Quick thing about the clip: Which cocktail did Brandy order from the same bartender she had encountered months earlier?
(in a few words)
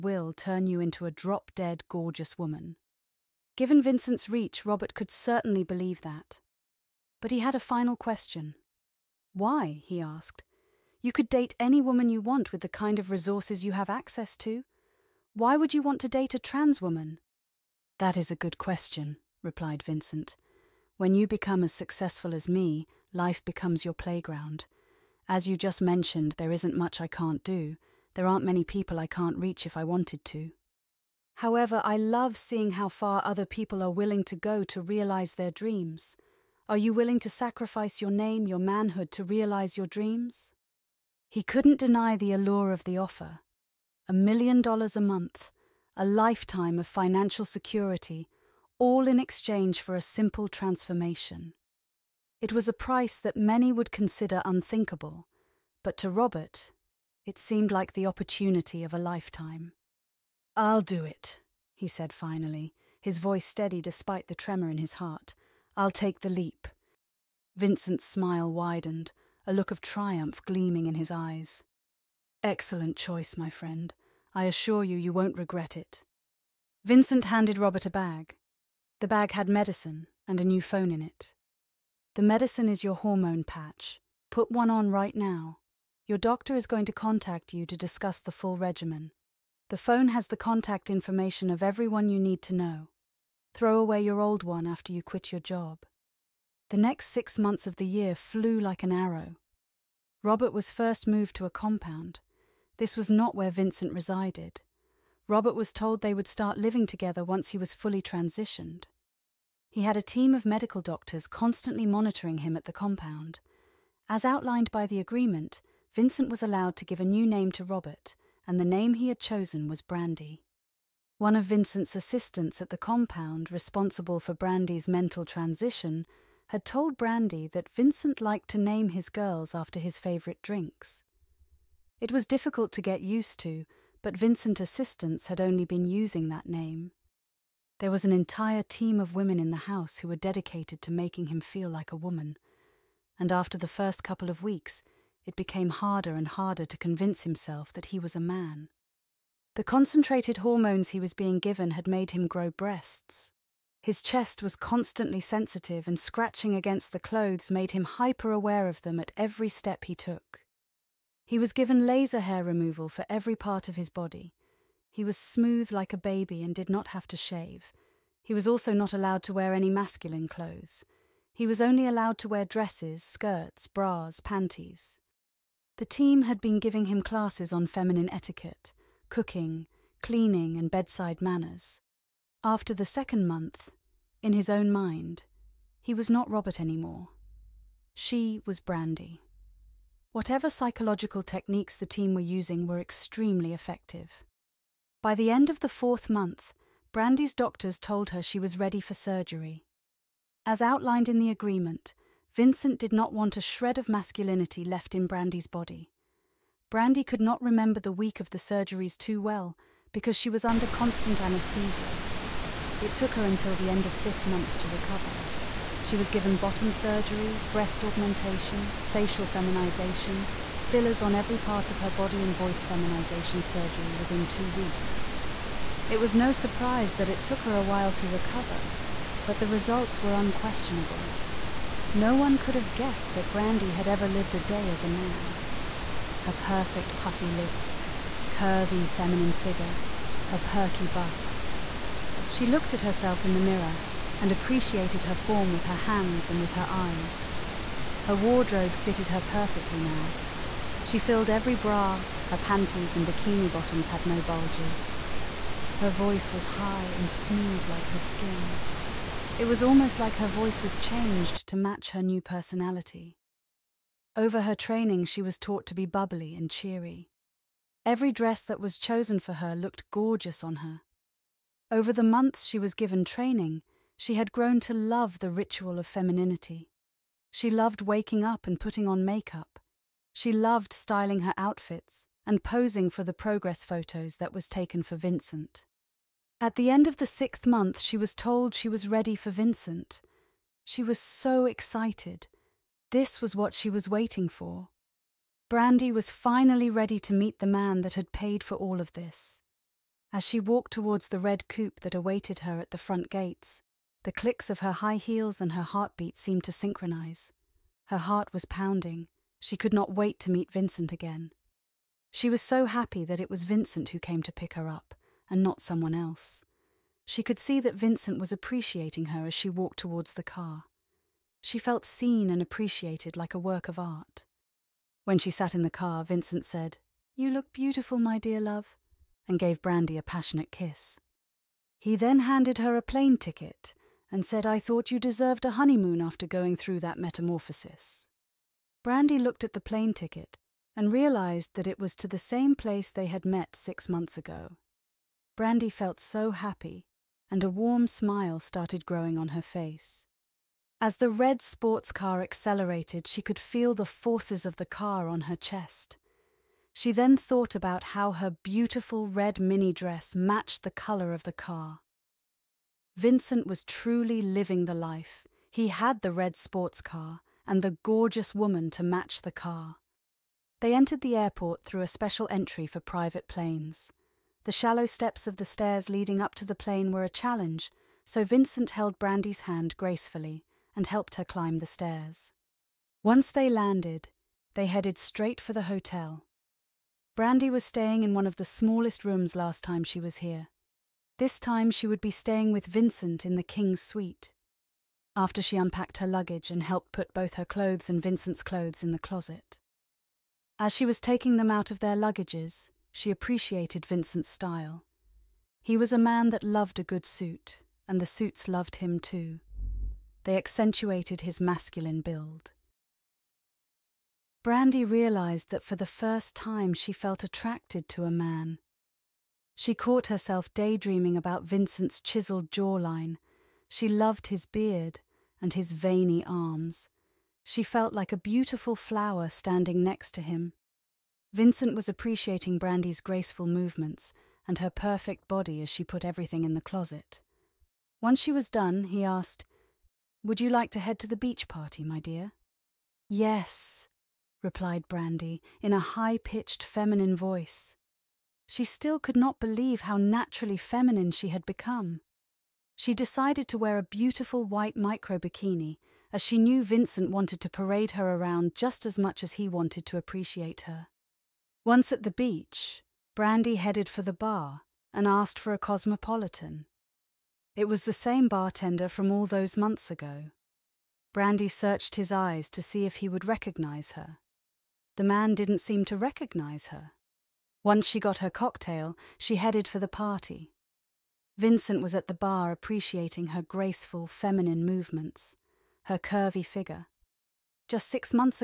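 cosmopolitan.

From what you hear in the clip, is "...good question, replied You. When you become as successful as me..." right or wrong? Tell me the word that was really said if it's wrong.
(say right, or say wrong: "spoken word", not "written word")
wrong: "Vincent", not "You".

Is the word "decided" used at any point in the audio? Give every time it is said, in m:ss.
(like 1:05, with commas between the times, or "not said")
7:32.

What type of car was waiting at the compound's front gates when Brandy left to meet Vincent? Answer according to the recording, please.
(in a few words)
coupe.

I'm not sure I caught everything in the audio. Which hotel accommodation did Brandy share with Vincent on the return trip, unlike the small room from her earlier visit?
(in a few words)
King's suite.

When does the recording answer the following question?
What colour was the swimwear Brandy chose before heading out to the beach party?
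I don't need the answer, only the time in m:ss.
7:34.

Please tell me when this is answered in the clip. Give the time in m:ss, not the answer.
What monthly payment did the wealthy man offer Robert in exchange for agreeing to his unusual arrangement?
0:44.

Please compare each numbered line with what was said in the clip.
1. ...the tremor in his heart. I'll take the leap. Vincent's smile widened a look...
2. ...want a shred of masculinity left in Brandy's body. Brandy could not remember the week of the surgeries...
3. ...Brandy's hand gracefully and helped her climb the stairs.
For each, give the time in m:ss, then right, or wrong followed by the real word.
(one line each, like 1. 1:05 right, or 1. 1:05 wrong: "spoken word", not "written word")
1. 1:04 right
2. 3:23 right
3. 6:18 right.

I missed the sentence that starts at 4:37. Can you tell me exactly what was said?
She loved waking up and putting on makeup.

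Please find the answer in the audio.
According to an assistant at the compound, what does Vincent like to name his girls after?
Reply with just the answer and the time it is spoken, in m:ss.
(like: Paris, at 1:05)
his favourite drinks, at 2:09.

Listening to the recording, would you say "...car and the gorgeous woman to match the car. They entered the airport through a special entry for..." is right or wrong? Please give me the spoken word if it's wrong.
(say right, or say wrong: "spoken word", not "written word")
right.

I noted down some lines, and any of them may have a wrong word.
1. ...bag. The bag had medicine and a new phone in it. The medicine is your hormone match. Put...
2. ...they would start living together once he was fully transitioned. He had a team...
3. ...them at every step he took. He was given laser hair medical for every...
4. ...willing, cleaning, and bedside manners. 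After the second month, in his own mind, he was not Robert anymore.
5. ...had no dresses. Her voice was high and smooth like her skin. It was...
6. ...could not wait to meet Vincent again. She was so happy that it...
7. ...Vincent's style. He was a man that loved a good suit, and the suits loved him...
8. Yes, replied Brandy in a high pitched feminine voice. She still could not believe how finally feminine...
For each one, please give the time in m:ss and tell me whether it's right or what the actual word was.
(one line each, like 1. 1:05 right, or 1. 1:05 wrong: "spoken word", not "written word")
1. 1:17 wrong: "patch", not "match"
2. 1:45 right
3. 2:38 wrong: "removal", not "medical"
4. 2:59 wrong: "cooking", not "willing"
5. 4:13 wrong: "bulges", not "dresses"
6. 5:09 right
7. 6:43 right
8. 7:23 wrong: "naturally", not "finally".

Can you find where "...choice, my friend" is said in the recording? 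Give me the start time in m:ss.
1:12.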